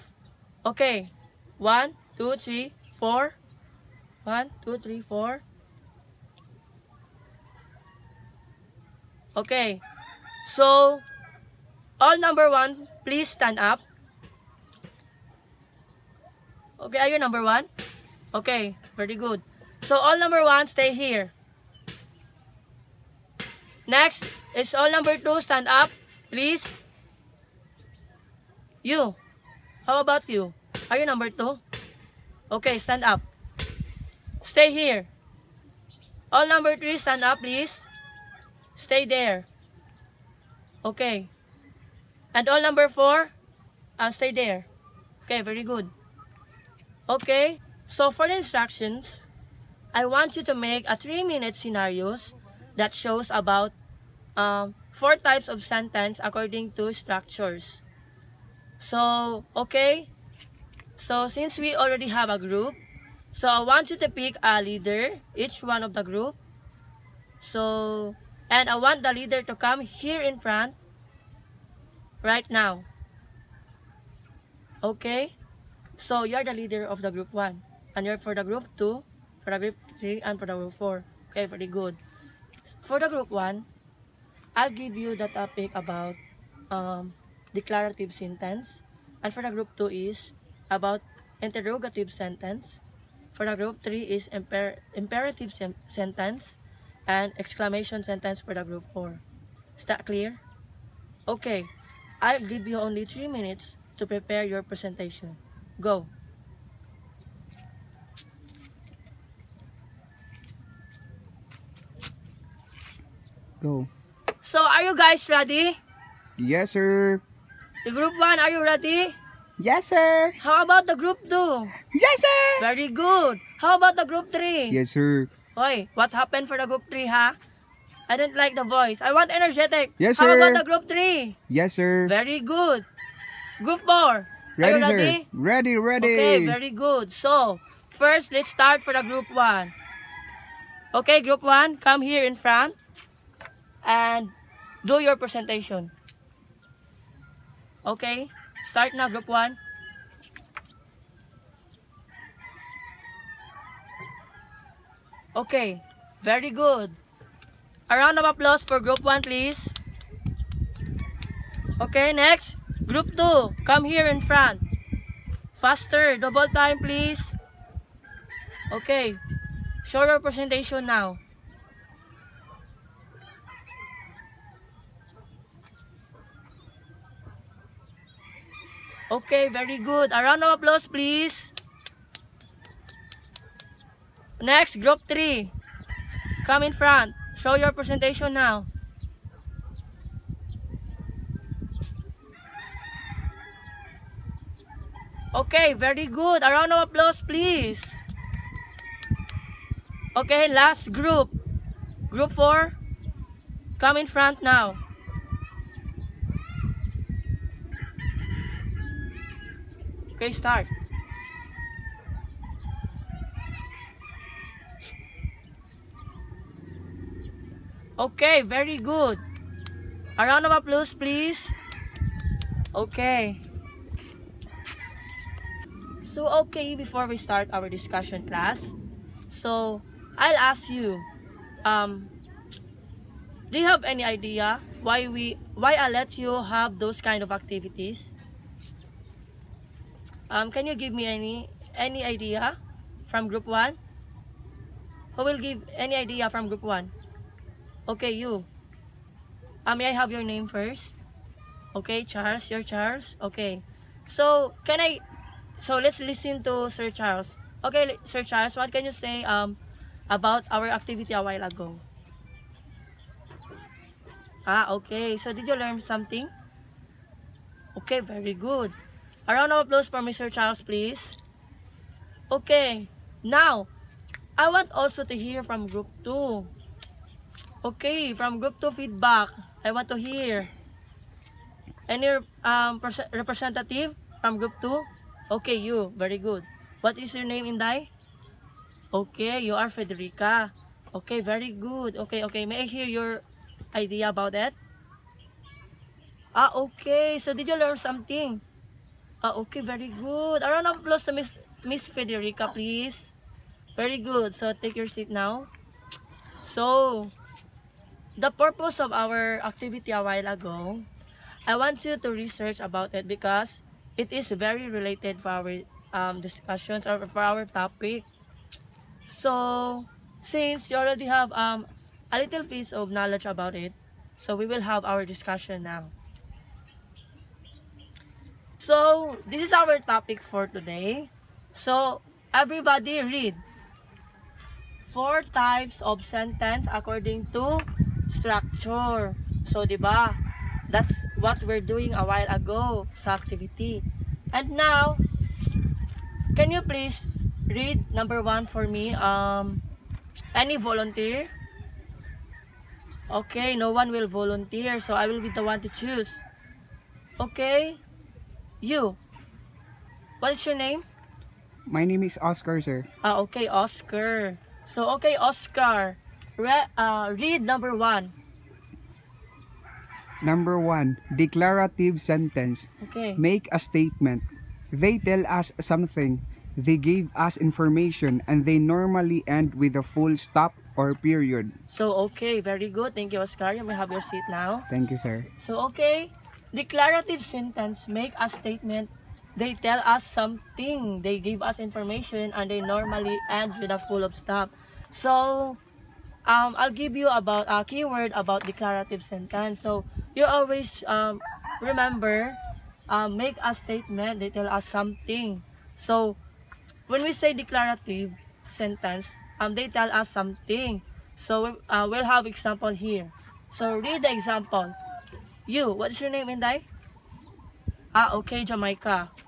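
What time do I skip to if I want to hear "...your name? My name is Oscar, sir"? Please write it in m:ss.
6:00.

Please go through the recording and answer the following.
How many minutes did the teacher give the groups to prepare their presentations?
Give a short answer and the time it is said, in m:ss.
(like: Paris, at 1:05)
3, at 1:43.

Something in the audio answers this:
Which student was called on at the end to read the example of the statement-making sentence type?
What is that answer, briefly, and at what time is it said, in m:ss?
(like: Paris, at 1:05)
Jamaica, at 6:58.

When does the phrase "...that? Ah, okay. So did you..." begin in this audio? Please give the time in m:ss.
4:54.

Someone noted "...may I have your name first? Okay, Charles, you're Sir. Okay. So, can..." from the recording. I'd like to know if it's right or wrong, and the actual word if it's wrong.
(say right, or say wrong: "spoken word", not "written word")
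wrong: "Charles", not "Sir".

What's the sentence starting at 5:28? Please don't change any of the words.
So, this is our topic for today.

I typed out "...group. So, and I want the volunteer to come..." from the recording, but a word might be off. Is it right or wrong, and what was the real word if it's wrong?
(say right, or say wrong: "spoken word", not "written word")
wrong: "leader", not "volunteer".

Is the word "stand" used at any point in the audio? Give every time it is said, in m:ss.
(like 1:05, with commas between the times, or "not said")
0:13, 0:25, 0:32, 0:36.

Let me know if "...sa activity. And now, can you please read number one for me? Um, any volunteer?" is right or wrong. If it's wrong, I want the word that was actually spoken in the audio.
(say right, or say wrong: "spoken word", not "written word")
right.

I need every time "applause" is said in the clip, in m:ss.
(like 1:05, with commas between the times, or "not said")
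2:38, 3:00, 3:16, 3:40, 4:29, 5:00.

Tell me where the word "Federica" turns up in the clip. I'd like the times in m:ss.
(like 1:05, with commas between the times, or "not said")
4:49, 5:01.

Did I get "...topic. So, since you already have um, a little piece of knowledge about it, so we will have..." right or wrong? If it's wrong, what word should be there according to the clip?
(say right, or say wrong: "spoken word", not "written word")
right.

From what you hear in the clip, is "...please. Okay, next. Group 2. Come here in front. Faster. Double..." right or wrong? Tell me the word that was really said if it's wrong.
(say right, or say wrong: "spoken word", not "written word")
right.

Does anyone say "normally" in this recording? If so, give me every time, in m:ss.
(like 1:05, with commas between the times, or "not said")
6:18, 6:32.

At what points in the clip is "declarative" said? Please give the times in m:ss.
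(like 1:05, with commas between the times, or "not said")
1:27, 6:11, 6:26, 6:38, 6:47.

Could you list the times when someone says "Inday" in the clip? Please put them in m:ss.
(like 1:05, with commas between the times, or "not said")
4:47, 6:56.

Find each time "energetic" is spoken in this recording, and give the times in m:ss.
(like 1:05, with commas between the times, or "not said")
2:09.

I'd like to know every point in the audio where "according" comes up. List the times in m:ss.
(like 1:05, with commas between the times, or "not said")
0:56, 5:36.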